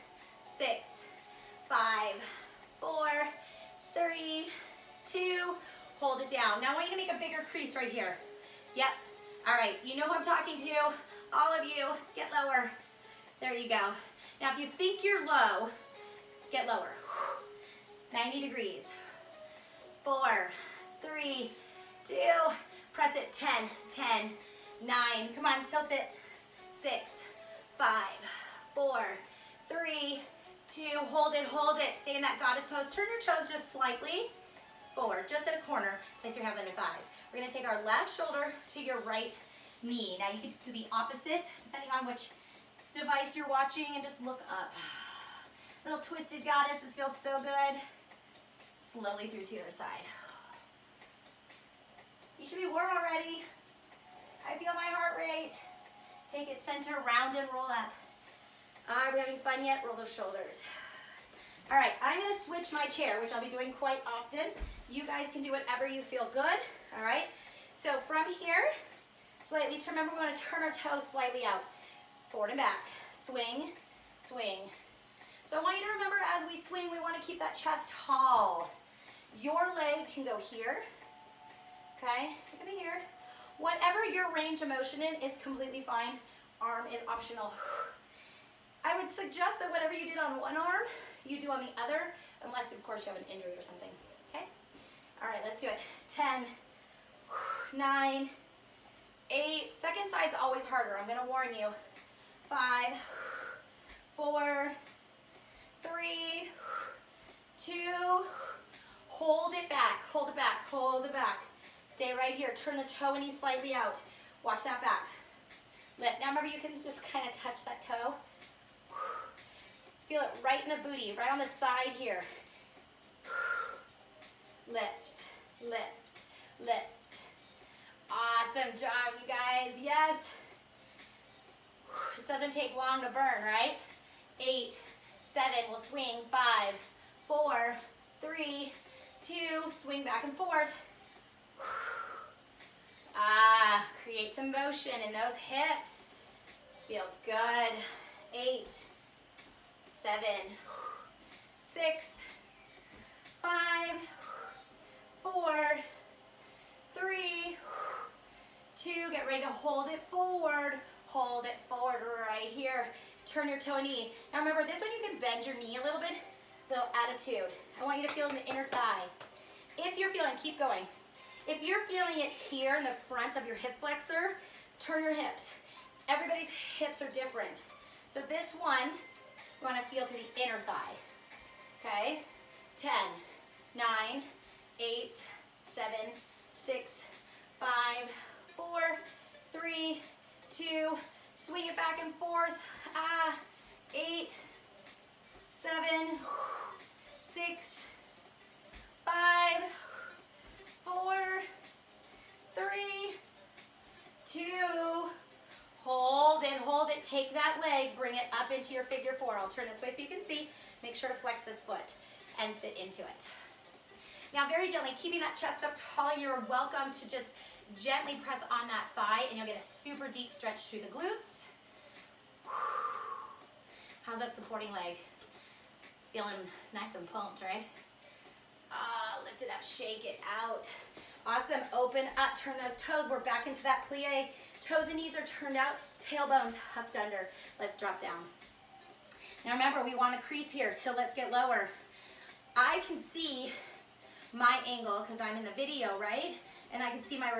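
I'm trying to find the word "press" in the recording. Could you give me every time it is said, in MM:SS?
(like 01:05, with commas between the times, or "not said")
00:22, 03:38.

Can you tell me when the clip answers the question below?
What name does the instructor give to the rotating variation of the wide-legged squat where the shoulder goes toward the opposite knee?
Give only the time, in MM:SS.
00:46.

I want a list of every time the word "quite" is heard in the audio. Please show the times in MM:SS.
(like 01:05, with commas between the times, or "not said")
01:03.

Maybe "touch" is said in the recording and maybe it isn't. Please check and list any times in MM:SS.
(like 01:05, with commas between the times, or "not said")
01:57.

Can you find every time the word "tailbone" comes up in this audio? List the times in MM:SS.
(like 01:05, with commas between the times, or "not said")
03:56.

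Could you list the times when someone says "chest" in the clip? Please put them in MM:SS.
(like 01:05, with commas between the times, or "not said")
01:17, 03:35.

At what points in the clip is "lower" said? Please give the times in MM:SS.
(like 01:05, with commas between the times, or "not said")
00:12, 00:16, 04:01.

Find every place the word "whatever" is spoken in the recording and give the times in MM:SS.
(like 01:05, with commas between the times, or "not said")
01:05, 01:23, 01:29.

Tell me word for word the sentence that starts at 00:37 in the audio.
We're gonna take our left shoulder to your right knee.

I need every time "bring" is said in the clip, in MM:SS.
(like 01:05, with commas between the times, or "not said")
03:27.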